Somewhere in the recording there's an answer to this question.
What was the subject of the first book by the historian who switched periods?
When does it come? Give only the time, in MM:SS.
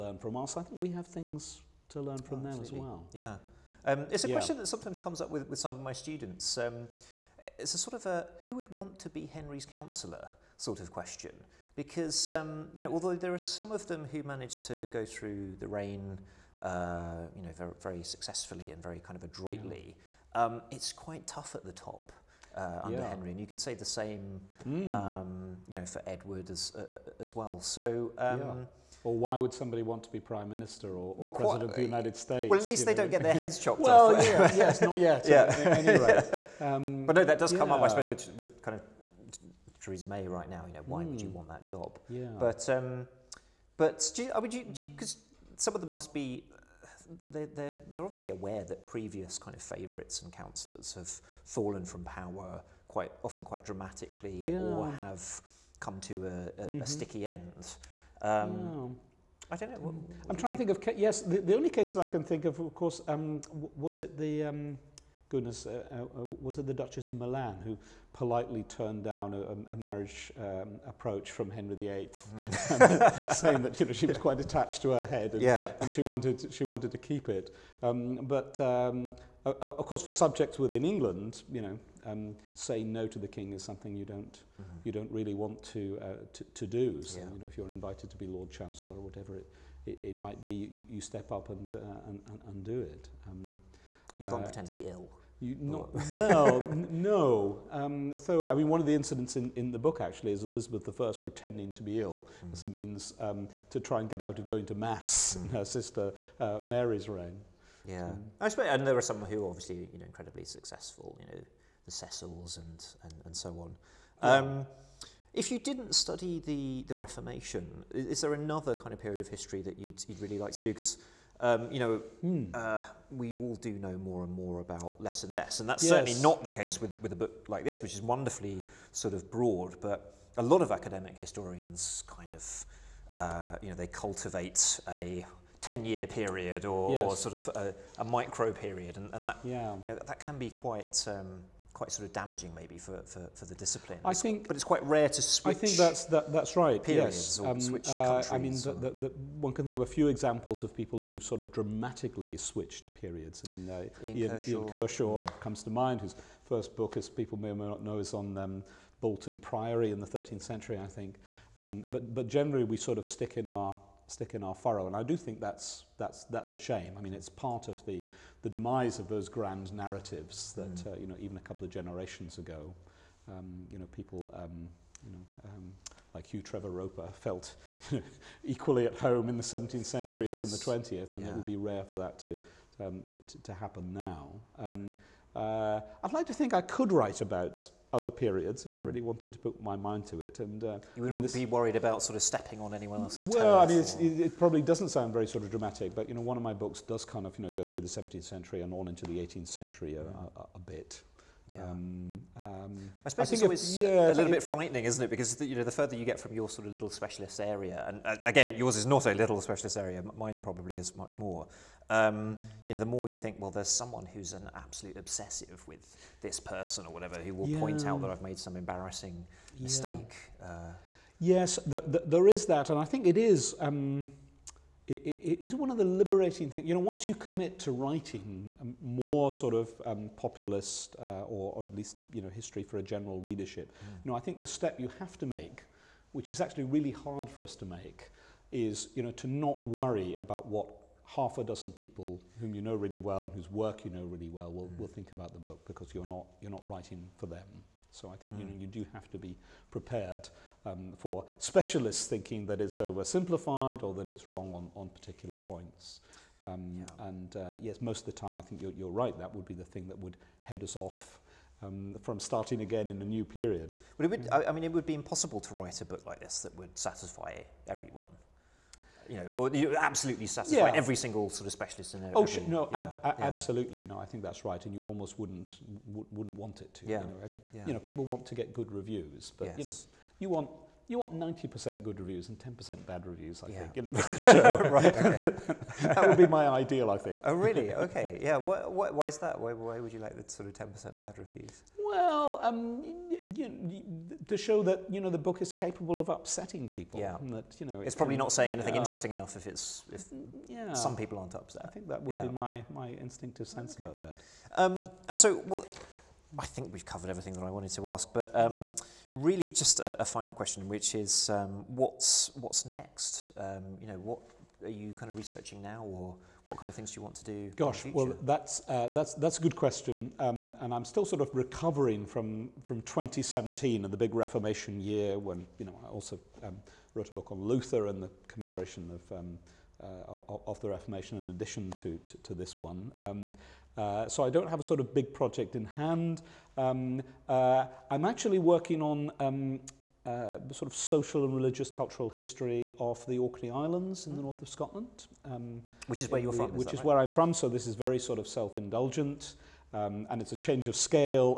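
02:38.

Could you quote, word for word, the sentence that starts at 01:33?
Um, you can't uh, pretend to be ill.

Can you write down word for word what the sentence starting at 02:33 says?
I mean, uh, Ian, Ian, Kershaw, Ian Kershaw mm.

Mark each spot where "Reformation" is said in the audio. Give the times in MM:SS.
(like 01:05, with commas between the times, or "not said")
01:56, 05:24, 05:30.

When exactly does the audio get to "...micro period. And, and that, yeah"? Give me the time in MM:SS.
02:18.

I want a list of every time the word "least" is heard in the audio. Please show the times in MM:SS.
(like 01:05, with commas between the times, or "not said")
00:32, 03:51.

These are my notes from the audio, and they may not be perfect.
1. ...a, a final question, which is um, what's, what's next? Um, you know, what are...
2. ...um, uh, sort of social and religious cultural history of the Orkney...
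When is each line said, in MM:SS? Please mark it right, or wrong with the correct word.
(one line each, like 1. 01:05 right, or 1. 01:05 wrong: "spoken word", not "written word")
1. 05:09 right
2. 05:39 right.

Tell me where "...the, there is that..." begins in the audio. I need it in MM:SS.
03:41.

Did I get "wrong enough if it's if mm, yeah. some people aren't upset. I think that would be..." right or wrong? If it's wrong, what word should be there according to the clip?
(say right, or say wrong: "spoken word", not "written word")
wrong: "interesting", not "wrong".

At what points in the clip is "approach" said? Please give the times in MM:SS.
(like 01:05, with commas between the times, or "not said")
01:10.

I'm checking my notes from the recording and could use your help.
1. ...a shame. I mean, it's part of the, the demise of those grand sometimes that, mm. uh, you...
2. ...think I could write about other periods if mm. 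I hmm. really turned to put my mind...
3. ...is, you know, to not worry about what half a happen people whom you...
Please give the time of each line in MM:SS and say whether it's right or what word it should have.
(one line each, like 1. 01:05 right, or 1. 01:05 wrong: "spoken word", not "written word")
1. 02:46 wrong: "narratives", not "sometimes"
2. 03:06 wrong: "wanted", not "turned"
3. 03:58 wrong: "dozen", not "happen".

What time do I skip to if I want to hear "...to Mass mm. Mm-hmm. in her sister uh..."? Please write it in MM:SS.
01:44.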